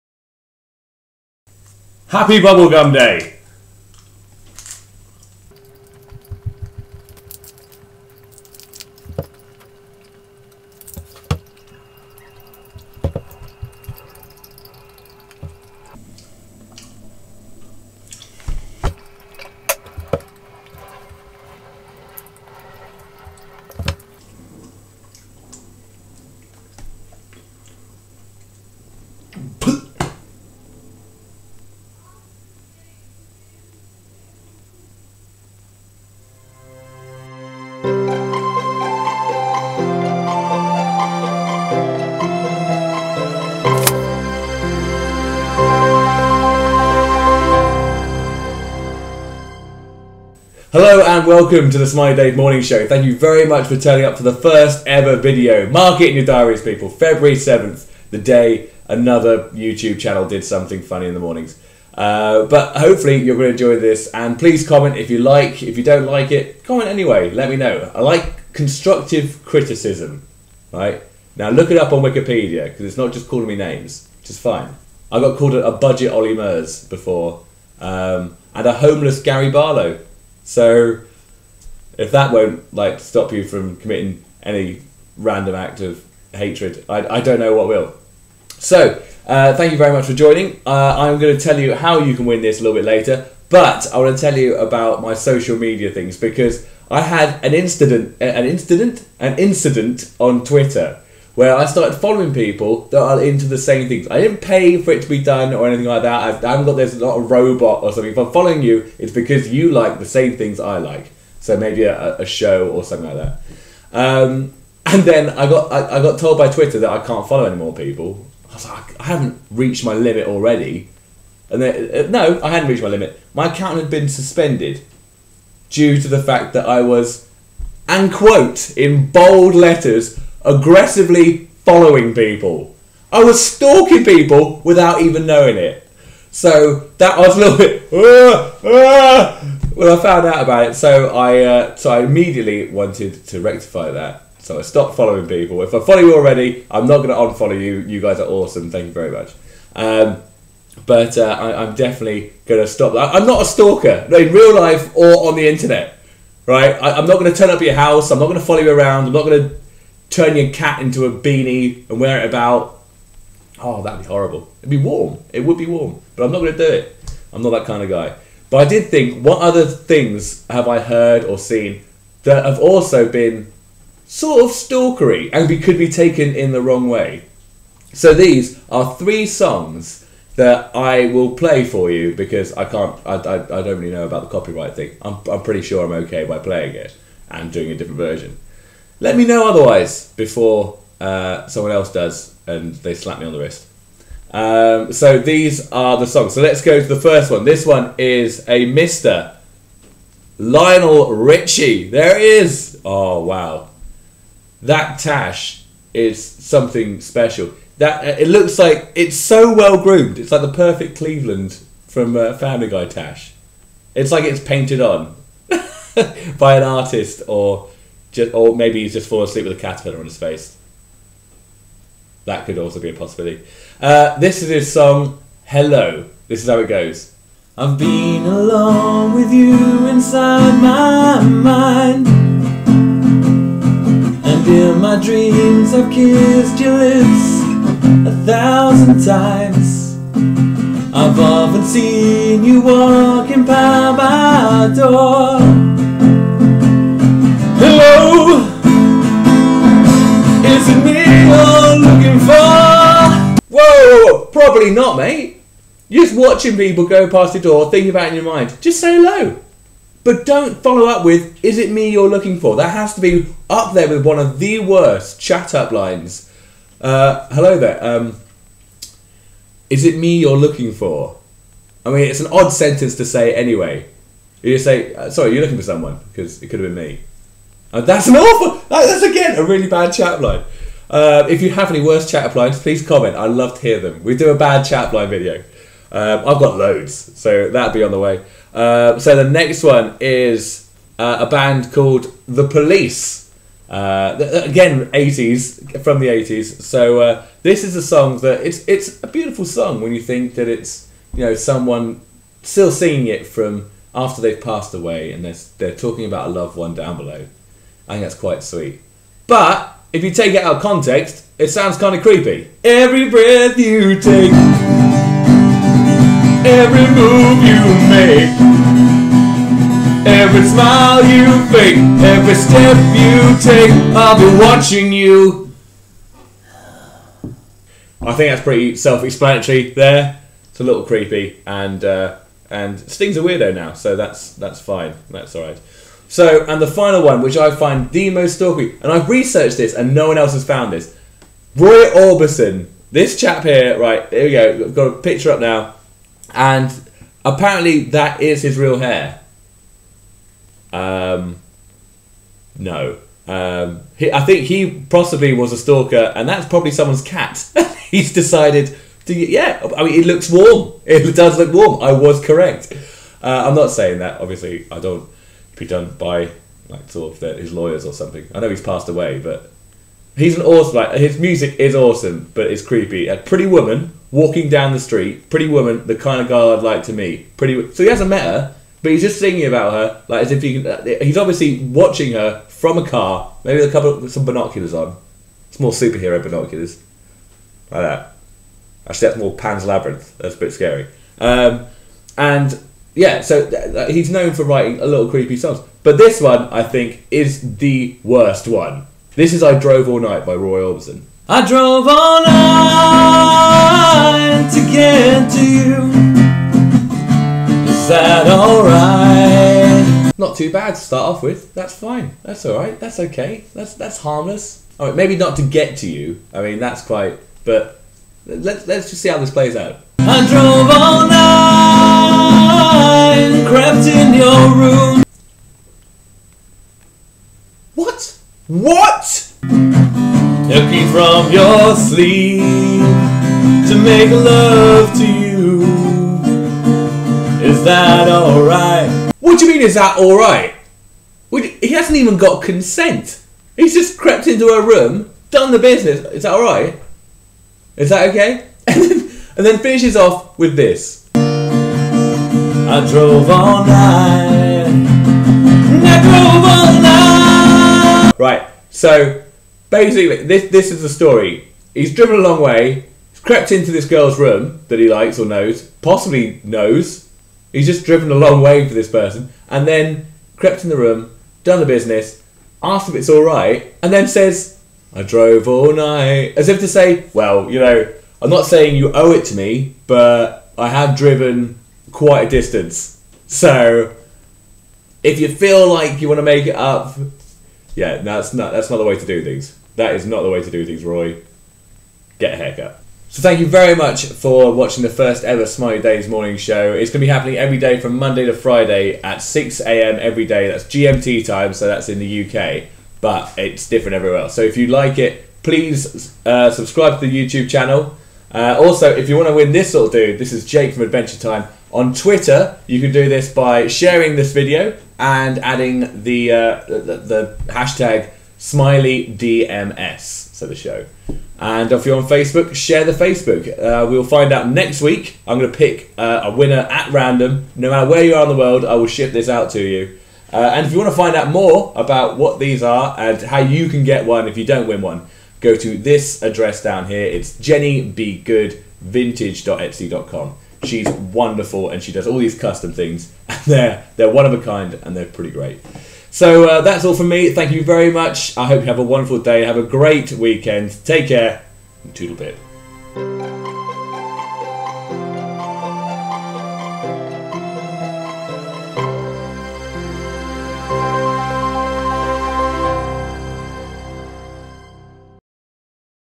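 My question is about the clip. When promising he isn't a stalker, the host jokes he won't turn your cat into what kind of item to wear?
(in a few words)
a beanie.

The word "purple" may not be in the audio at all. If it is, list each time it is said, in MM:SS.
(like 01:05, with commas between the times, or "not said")
not said.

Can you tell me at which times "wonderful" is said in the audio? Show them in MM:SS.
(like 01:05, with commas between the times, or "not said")
09:00, 09:08.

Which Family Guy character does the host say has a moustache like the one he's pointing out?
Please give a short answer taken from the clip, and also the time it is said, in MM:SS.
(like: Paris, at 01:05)
Cleveland, at 03:30.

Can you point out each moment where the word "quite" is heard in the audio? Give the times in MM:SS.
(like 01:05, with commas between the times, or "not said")
05:08, 06:56, 08:01.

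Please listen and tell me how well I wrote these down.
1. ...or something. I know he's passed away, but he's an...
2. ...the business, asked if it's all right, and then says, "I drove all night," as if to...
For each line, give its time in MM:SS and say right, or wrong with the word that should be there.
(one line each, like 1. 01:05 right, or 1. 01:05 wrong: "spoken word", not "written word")
1. 06:07 right
2. 07:51 right.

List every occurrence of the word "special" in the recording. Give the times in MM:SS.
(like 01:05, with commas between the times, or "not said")
03:27.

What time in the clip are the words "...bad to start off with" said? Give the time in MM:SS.
06:50.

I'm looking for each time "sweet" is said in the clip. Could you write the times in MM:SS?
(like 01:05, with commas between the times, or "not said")
05:08.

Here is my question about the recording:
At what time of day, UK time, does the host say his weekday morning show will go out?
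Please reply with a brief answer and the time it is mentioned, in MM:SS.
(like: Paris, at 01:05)
6 a.m., at 08:19.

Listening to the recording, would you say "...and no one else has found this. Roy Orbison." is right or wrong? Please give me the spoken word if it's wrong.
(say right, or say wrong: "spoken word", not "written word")
right.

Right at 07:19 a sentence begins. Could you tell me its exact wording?
What do you mean, is that alright?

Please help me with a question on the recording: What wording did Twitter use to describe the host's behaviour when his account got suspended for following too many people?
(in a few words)
aggressively following.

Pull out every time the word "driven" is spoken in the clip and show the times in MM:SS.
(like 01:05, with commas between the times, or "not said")
07:41, 07:47, 08:00.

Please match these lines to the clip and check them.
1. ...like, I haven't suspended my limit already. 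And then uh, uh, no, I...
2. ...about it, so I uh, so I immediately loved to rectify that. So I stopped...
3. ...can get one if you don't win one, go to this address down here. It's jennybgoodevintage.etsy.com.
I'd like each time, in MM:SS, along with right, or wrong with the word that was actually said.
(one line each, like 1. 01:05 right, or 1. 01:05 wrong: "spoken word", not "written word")
1. 01:58 wrong: "reached", not "suspended"
2. 02:20 wrong: "wanted", not "loved"
3. 08:53 right.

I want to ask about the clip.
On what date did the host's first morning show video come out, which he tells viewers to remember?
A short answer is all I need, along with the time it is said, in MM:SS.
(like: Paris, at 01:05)
February 7th, at 00:56.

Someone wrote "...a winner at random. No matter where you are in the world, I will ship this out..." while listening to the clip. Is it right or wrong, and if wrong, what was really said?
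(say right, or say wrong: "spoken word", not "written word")
right.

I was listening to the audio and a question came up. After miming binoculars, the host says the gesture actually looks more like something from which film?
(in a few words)
Pan's Labyrinth.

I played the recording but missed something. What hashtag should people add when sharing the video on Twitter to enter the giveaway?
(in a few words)
SmileyDMS.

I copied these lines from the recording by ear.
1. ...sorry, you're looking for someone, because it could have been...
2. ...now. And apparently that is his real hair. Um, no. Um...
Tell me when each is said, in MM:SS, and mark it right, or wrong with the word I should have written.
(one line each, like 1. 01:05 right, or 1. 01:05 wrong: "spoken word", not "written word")
1. 04:35 right
2. 05:45 right.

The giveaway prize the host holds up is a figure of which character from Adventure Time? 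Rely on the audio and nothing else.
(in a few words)
Jake.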